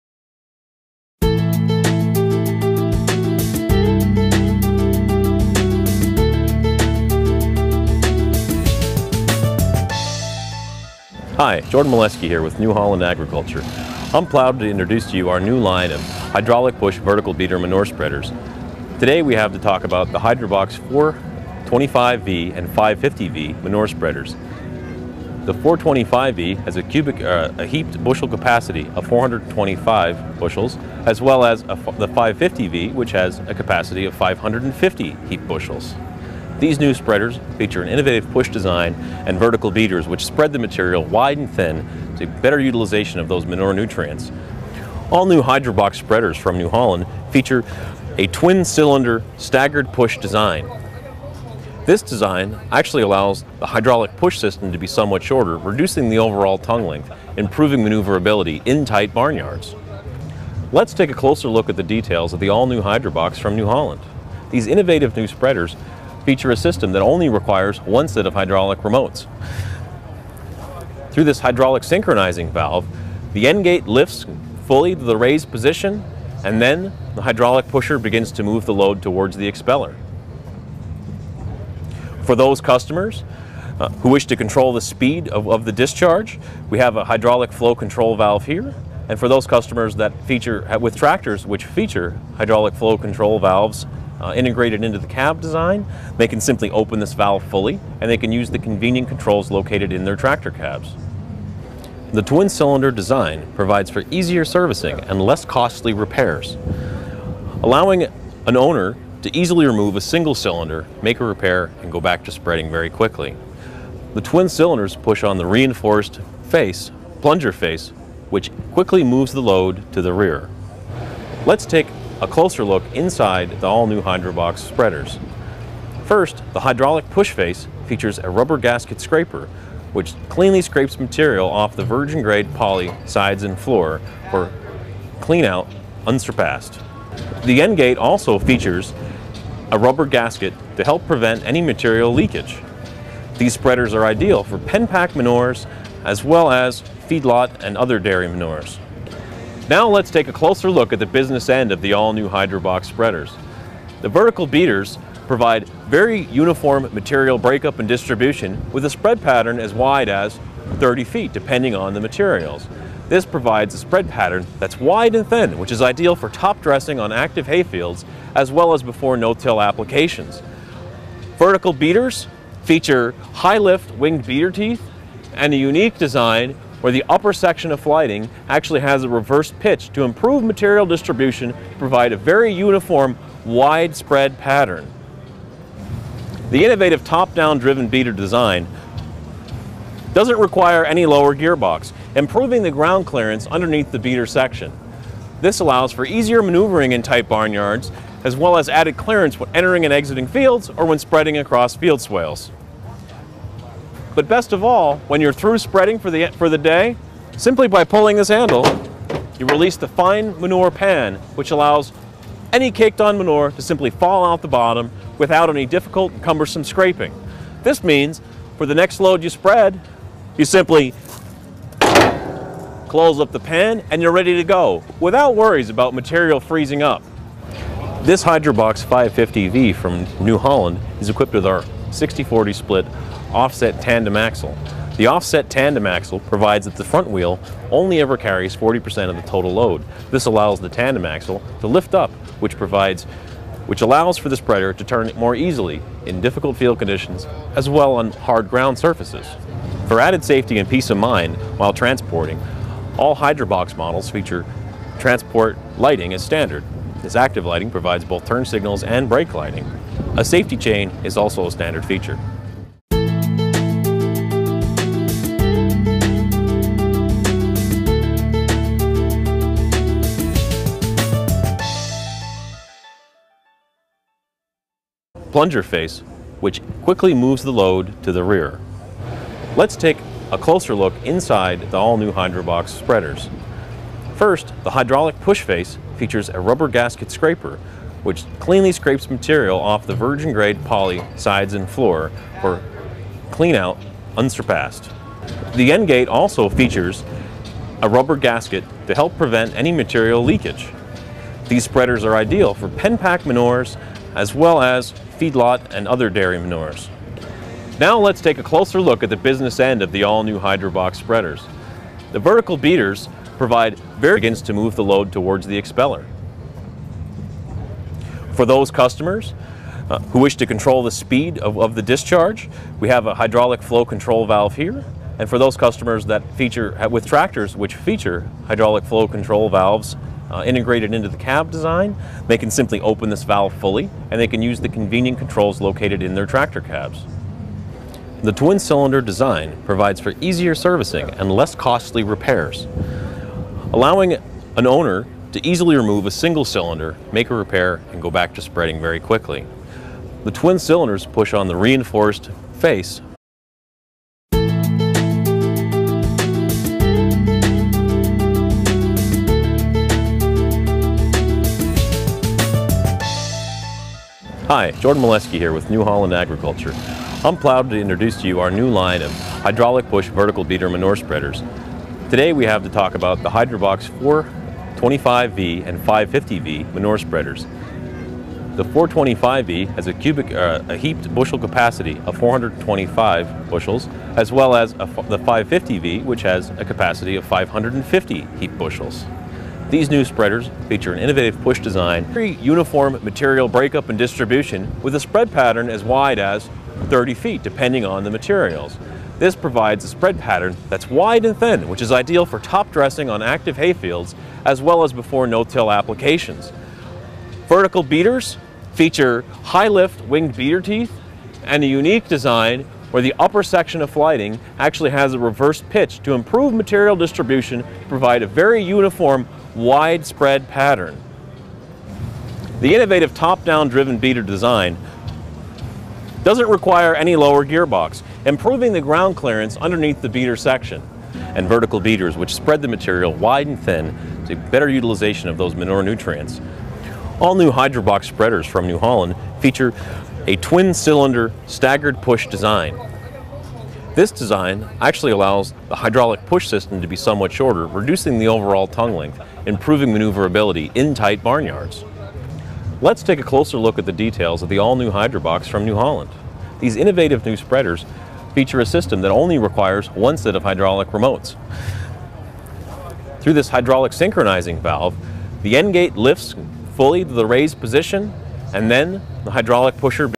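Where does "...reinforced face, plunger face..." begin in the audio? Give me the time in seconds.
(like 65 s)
115 s.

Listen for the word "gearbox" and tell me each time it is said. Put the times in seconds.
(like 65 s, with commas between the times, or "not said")
191 s, 427 s.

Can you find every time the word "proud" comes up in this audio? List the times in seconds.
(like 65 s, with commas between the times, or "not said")
14 s, 367 s.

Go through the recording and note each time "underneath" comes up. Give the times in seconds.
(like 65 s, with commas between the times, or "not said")
193 s, 429 s.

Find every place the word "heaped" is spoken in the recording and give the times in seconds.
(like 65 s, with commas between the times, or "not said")
27 s, 35 s, 380 s, 388 s.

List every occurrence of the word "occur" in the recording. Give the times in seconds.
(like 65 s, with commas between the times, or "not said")
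not said.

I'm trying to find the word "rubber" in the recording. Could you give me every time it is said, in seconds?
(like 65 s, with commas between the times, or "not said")
128 s, 139 s, 286 s, 297 s.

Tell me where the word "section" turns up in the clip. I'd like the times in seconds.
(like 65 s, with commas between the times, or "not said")
177 s, 194 s, 413 s, 430 s.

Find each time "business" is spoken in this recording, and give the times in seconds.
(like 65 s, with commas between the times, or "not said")
151 s, 309 s.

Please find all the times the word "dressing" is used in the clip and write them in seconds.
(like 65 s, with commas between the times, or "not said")
166 s, 402 s.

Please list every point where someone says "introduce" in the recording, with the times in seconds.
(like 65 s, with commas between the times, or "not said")
14 s, 367 s.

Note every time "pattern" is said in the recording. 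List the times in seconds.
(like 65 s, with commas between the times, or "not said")
159 s, 164 s, 184 s, 395 s, 400 s, 420 s.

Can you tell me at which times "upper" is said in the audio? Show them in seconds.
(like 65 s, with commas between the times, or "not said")
177 s, 413 s.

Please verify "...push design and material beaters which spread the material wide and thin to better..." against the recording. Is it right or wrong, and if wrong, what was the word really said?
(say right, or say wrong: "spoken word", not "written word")
wrong: "vertical", not "material".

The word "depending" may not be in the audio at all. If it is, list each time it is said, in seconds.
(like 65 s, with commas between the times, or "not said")
161 s, 397 s.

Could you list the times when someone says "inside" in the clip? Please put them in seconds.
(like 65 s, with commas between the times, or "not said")
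122 s, 281 s.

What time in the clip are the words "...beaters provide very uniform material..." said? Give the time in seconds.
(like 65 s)
154 s.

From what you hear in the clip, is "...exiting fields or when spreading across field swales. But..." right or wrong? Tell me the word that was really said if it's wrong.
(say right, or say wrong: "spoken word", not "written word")
right.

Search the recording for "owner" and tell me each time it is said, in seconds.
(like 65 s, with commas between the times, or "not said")
108 s, 344 s.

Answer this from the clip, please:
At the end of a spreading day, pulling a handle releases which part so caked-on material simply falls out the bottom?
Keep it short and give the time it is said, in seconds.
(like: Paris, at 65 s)
fine manure pan, at 209 s.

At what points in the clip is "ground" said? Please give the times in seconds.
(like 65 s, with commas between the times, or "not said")
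192 s, 248 s, 428 s.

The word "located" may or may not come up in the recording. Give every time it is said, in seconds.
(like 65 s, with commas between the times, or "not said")
99 s, 335 s.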